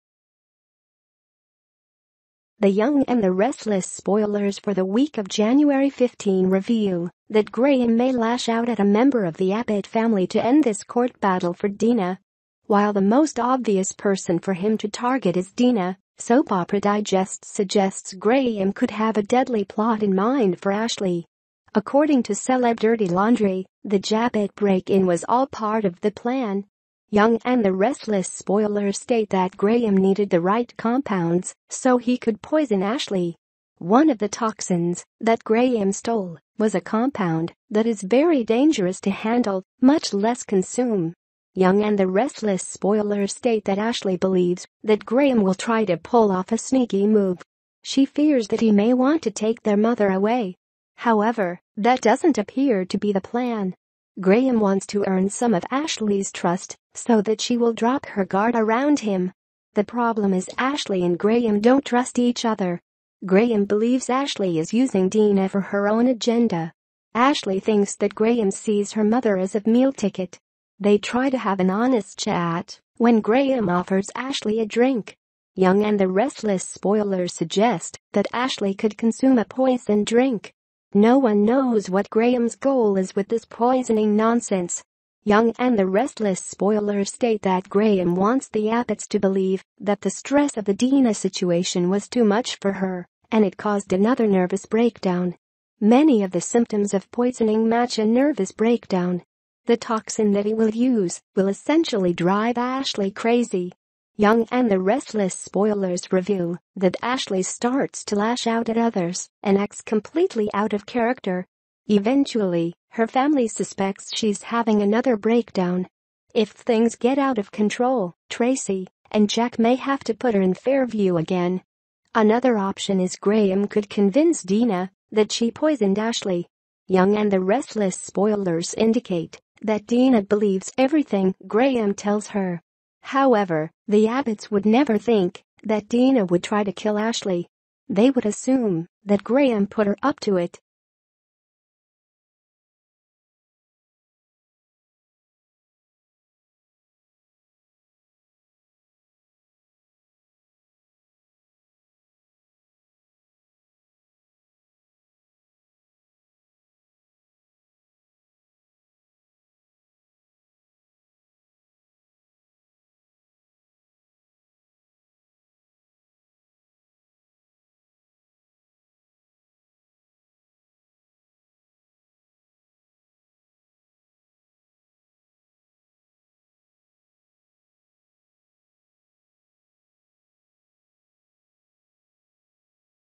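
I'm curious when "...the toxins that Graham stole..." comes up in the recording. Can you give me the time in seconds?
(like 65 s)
34 s.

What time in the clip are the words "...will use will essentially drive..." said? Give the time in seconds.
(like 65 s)
100 s.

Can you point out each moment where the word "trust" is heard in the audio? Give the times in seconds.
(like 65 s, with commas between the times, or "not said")
56 s, 61 s.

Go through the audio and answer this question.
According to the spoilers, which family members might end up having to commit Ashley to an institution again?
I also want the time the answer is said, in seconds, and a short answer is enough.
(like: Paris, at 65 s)
Tracy and Jack, at 118 s.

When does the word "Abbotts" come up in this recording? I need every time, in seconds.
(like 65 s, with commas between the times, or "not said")
9 s, 88 s, 134 s.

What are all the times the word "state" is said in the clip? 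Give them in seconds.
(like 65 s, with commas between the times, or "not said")
28 s, 43 s, 87 s.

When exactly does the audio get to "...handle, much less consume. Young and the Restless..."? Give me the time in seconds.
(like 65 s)
39 s.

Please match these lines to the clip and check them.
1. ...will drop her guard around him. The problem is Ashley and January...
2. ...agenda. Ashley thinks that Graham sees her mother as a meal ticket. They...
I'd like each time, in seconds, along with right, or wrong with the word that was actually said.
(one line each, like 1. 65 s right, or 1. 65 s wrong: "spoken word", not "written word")
1. 57 s wrong: "Graham", not "January"
2. 66 s right.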